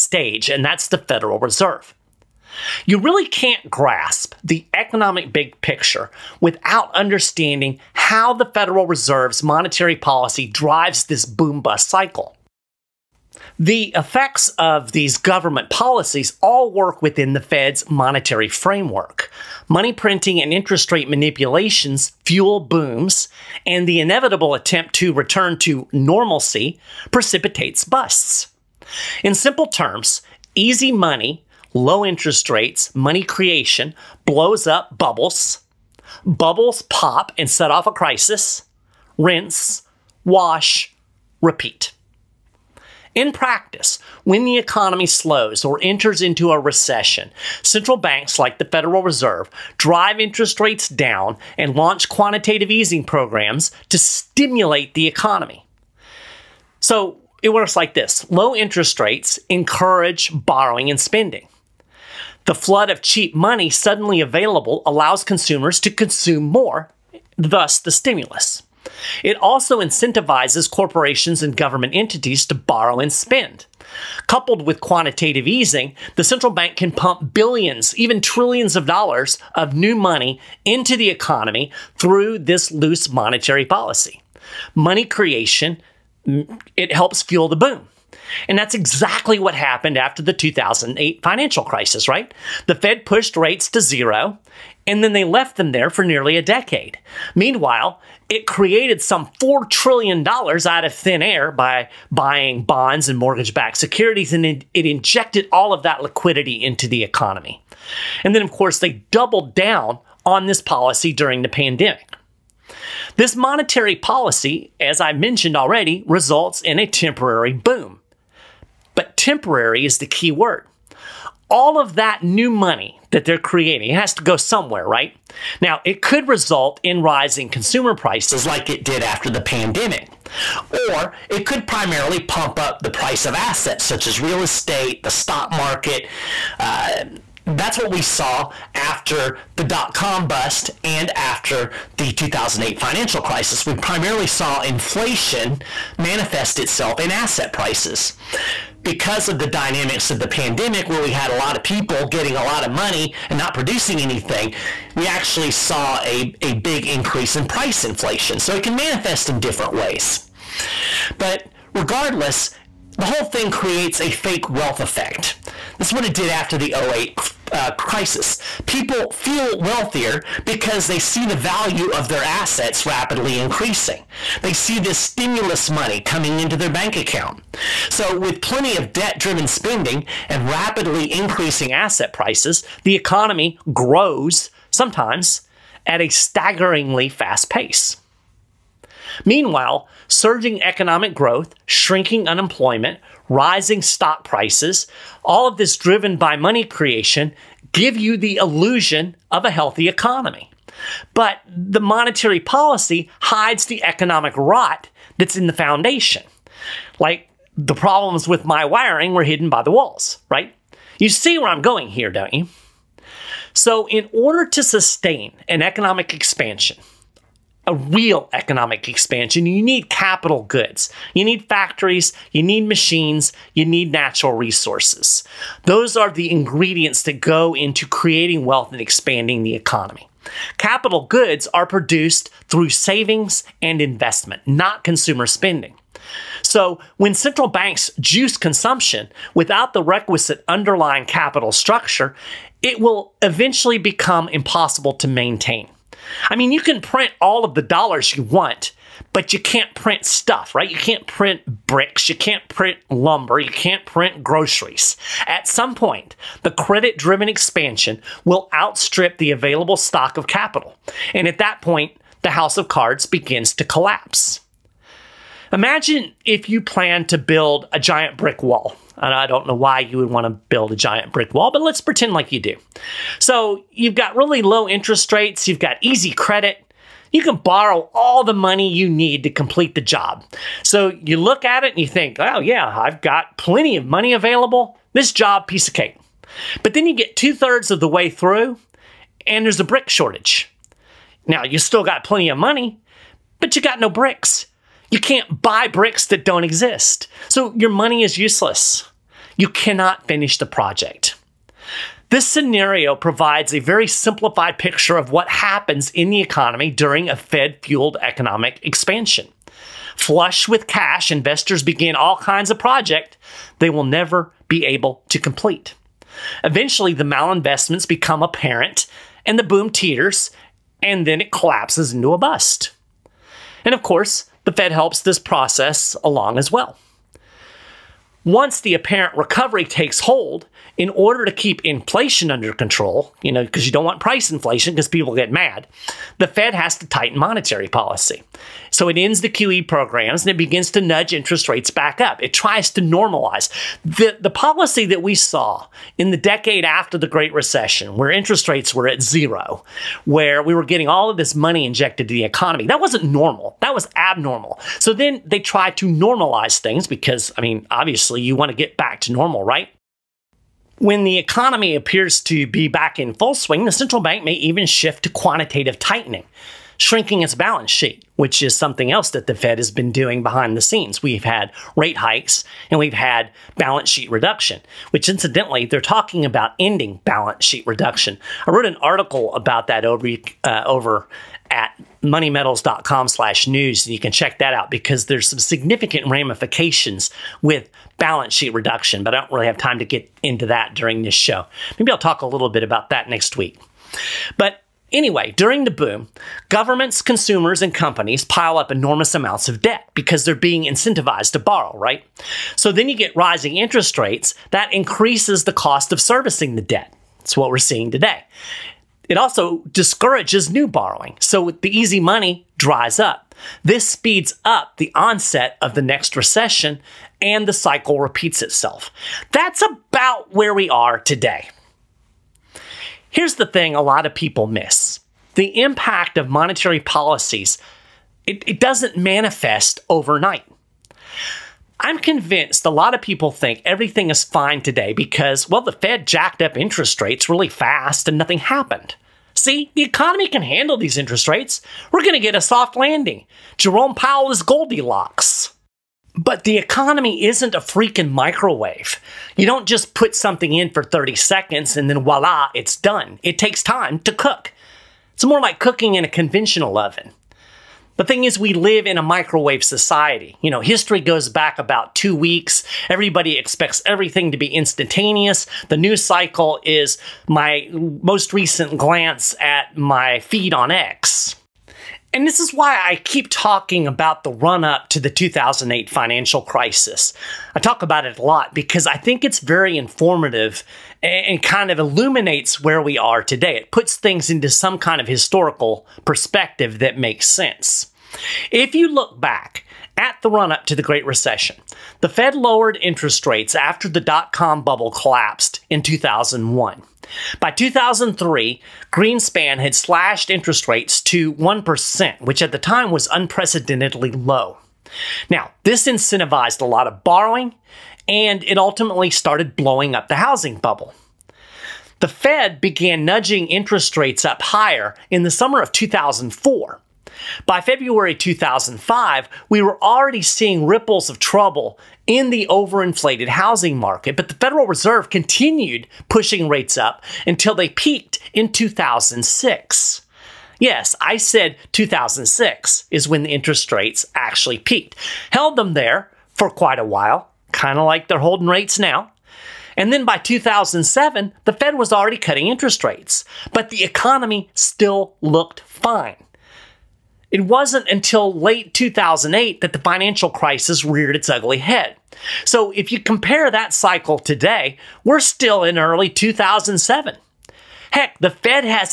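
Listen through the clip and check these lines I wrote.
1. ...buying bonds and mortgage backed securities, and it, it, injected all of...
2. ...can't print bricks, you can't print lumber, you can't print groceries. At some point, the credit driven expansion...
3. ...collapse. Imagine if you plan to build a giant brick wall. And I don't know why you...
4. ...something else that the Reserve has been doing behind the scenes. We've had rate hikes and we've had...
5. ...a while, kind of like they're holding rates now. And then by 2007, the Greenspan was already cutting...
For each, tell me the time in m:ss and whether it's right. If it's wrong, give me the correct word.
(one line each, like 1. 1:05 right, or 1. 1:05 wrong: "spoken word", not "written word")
1. 1:42 right
2. 4:10 right
3. 4:23 right
4. 6:08 wrong: "Fed", not "Reserve"
5. 8:56 wrong: "Fed", not "Greenspan".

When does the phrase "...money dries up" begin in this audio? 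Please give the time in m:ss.
6:51.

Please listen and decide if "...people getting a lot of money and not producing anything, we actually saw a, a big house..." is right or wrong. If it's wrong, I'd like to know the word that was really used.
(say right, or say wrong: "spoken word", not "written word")
wrong: "increase", not "house".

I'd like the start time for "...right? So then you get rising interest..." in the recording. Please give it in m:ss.
6:41.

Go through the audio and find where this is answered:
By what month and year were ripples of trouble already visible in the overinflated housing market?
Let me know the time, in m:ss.
8:37.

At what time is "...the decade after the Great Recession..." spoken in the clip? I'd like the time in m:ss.
5:46.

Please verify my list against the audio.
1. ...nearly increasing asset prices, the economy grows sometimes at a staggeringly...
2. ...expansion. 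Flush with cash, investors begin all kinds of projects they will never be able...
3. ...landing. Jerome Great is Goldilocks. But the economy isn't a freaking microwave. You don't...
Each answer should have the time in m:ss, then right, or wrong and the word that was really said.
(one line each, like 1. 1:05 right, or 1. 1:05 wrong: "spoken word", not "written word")
1. 3:00 wrong: "rapidly", not "nearly"
2. 5:08 right
3. 7:22 wrong: "Powell", not "Great".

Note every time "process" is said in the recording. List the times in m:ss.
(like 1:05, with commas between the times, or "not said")
5:25.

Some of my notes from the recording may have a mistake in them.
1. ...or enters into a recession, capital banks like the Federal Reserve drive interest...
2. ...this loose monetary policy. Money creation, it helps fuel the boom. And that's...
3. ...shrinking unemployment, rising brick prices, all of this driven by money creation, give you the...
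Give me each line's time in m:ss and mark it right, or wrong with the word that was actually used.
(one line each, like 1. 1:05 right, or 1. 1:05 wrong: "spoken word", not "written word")
1. 0:45 wrong: "central", not "capital"
2. 1:22 right
3. 3:11 wrong: "stock", not "brick".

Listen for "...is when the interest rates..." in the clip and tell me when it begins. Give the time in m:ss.
8:52.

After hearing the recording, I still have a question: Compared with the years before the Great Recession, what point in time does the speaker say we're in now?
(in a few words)
early 2007.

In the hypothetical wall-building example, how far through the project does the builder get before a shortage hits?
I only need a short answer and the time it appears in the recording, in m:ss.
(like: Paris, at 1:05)
two thirds, at 4:47.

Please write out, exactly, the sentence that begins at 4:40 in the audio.
So you look at it and you think, oh yeah, I've got plenty of money available.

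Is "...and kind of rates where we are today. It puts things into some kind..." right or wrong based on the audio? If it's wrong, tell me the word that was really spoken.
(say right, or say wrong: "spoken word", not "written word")
wrong: "illuminates", not "rates".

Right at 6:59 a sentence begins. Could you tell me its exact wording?
That's about where we are today.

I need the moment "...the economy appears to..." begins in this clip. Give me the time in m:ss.
6:01.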